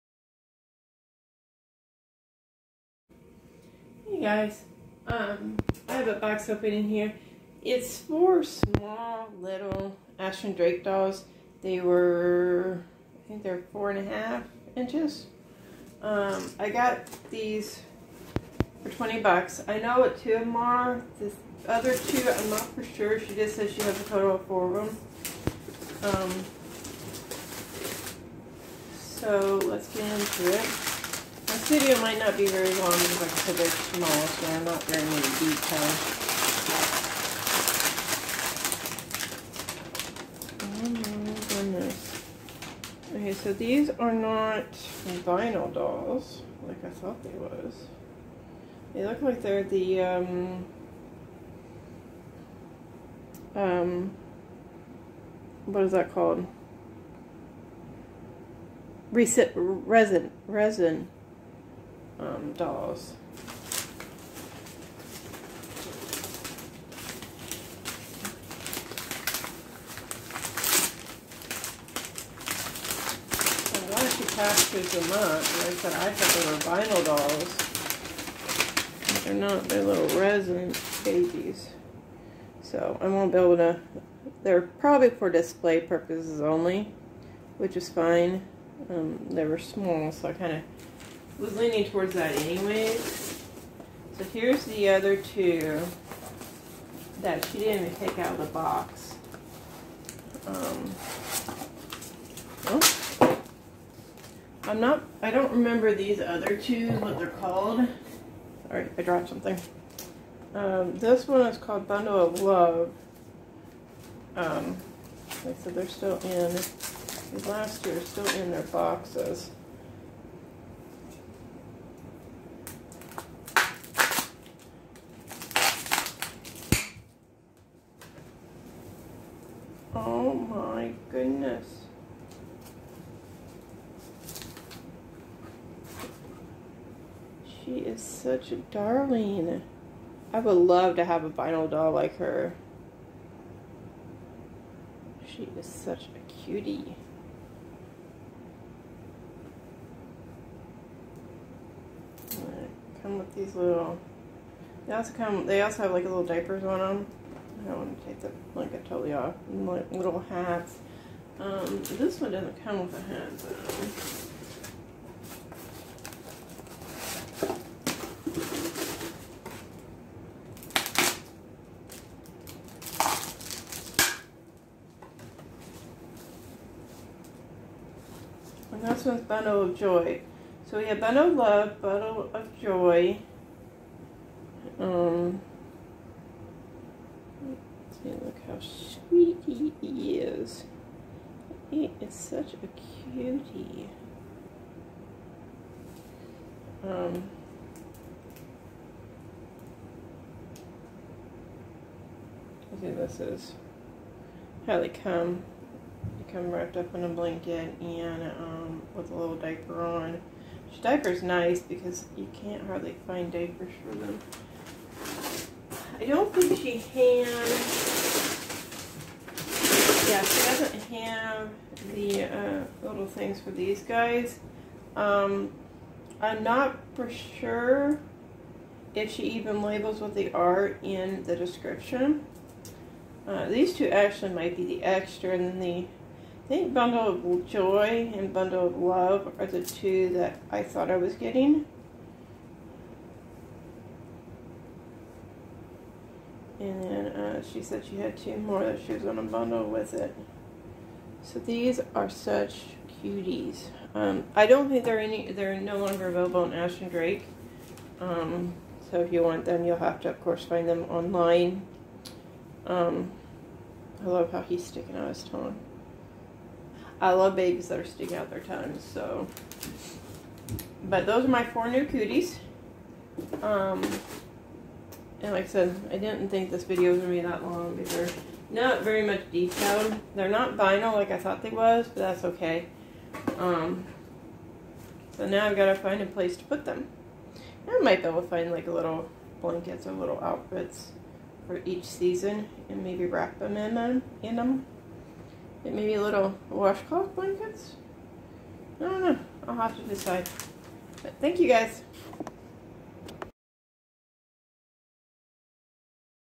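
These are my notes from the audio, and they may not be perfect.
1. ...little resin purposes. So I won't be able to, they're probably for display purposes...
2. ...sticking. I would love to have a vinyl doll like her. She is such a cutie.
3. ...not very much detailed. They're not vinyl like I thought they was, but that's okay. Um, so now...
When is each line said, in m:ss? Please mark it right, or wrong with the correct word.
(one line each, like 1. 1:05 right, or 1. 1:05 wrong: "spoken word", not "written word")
1. 1:19 wrong: "babies", not "purposes"
2. 2:18 wrong: "darling", not "sticking"
3. 4:38 right.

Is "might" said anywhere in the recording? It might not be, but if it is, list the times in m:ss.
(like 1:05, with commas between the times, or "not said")
0:32, 3:54, 4:47.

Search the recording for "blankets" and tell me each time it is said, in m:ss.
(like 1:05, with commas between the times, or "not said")
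3:27, 4:49, 4:57.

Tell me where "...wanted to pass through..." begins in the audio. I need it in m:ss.
1:13.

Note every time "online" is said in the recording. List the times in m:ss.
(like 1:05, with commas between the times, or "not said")
4:20.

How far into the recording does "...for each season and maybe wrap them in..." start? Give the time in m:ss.
4:51.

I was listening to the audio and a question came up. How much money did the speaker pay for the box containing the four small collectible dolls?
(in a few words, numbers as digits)
$20.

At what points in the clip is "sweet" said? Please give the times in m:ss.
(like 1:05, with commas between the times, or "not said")
3:08.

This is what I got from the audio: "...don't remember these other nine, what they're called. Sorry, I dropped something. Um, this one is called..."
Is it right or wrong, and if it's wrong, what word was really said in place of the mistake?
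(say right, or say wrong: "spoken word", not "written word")
wrong: "two", not "nine".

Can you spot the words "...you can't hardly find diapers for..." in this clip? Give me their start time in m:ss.
3:32.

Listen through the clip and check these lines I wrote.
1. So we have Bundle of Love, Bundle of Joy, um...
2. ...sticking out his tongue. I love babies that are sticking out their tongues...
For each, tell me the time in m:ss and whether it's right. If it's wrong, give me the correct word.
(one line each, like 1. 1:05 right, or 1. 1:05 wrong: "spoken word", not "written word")
1. 3:00 right
2. 4:24 right.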